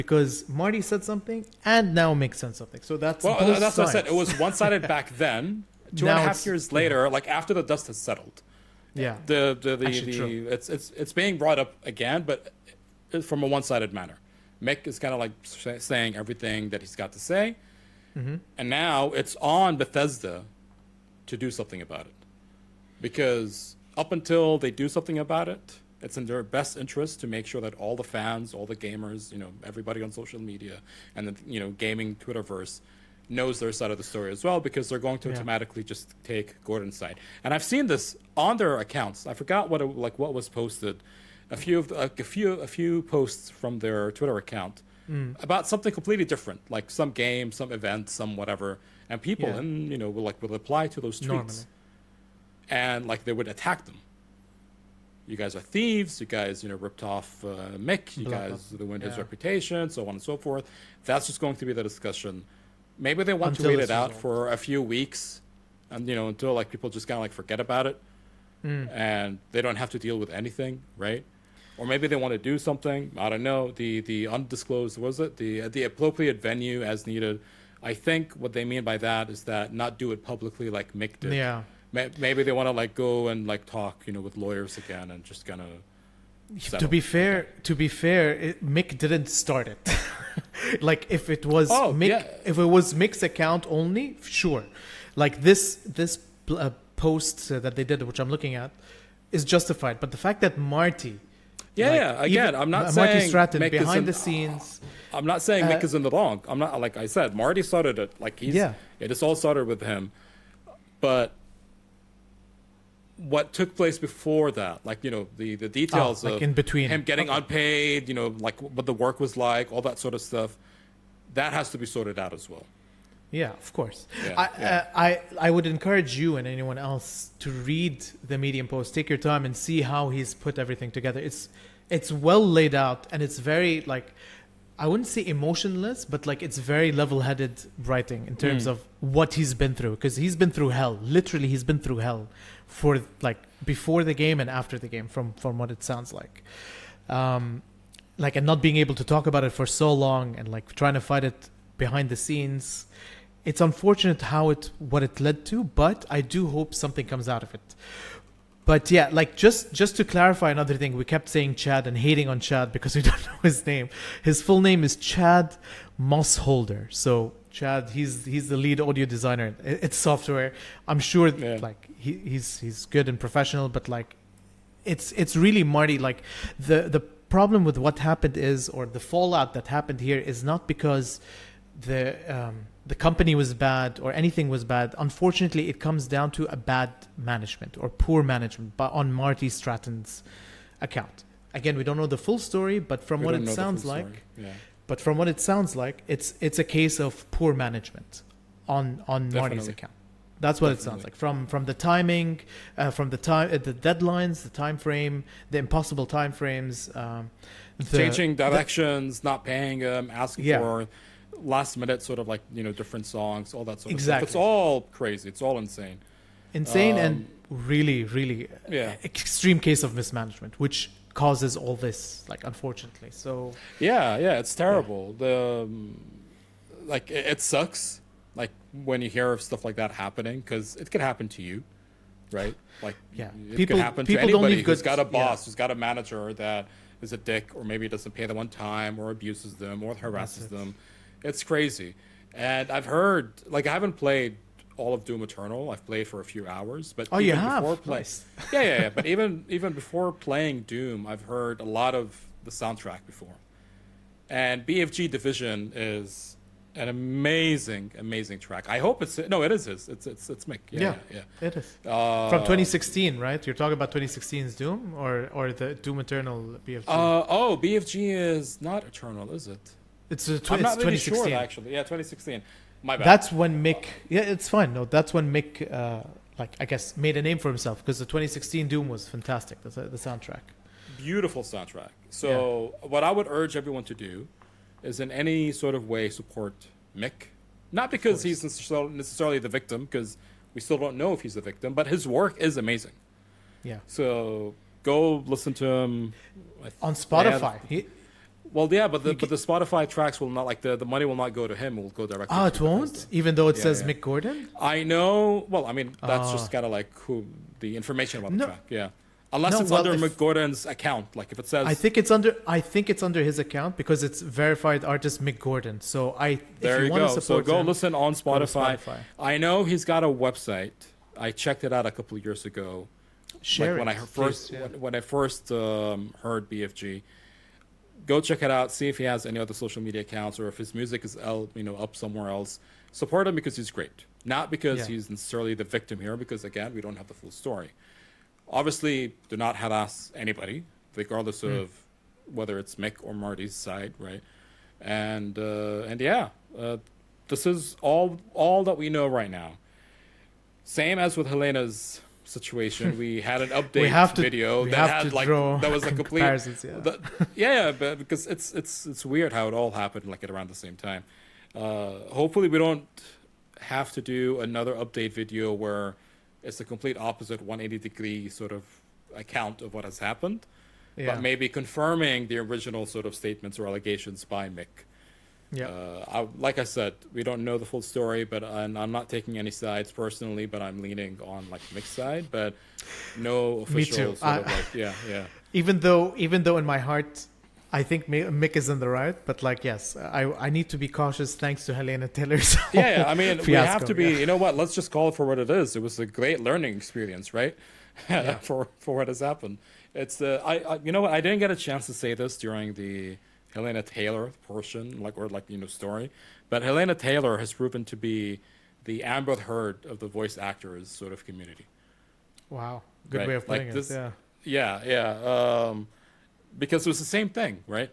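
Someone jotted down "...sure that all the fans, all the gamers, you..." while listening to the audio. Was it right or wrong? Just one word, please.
right.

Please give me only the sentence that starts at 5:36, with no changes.
Because again, we don't have the full story obviously do not have asked anybody, regardless mm.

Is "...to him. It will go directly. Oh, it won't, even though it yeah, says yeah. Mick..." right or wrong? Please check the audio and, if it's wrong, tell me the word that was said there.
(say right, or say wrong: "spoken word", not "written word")
right.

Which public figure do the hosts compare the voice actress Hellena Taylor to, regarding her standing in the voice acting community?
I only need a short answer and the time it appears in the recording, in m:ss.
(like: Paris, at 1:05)
Amber Heard, at 6:49.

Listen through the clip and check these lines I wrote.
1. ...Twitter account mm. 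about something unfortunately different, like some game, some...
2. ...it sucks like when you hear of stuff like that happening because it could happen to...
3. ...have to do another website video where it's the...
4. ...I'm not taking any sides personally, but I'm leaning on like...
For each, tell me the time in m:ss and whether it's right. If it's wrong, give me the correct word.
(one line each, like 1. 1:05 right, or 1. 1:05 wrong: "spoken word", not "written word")
1. 0:44 wrong: "completely", not "unfortunately"
2. 3:47 right
3. 6:03 wrong: "update", not "website"
4. 6:18 right.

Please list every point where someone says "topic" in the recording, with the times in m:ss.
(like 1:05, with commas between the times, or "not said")
not said.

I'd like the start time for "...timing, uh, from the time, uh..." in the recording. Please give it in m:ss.
3:21.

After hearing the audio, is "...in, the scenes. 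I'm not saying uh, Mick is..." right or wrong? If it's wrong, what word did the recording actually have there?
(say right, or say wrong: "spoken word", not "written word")
right.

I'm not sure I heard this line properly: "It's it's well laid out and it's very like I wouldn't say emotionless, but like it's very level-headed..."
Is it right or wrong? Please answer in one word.
right.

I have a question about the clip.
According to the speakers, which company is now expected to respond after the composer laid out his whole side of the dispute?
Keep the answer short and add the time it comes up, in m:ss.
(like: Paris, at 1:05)
Bethesda, at 0:19.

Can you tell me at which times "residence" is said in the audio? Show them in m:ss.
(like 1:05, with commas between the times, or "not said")
not said.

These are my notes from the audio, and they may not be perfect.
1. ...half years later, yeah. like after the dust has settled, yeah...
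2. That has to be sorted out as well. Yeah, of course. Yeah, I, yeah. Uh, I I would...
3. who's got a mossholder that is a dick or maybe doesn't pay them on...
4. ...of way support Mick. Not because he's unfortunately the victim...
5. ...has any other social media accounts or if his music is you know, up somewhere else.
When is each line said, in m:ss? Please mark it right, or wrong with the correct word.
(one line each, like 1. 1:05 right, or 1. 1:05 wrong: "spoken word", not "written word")
1. 0:06 right
2. 2:01 right
3. 3:55 wrong: "manager", not "mossholder"
4. 4:45 wrong: "necessarily", not "unfortunately"
5. 5:29 right.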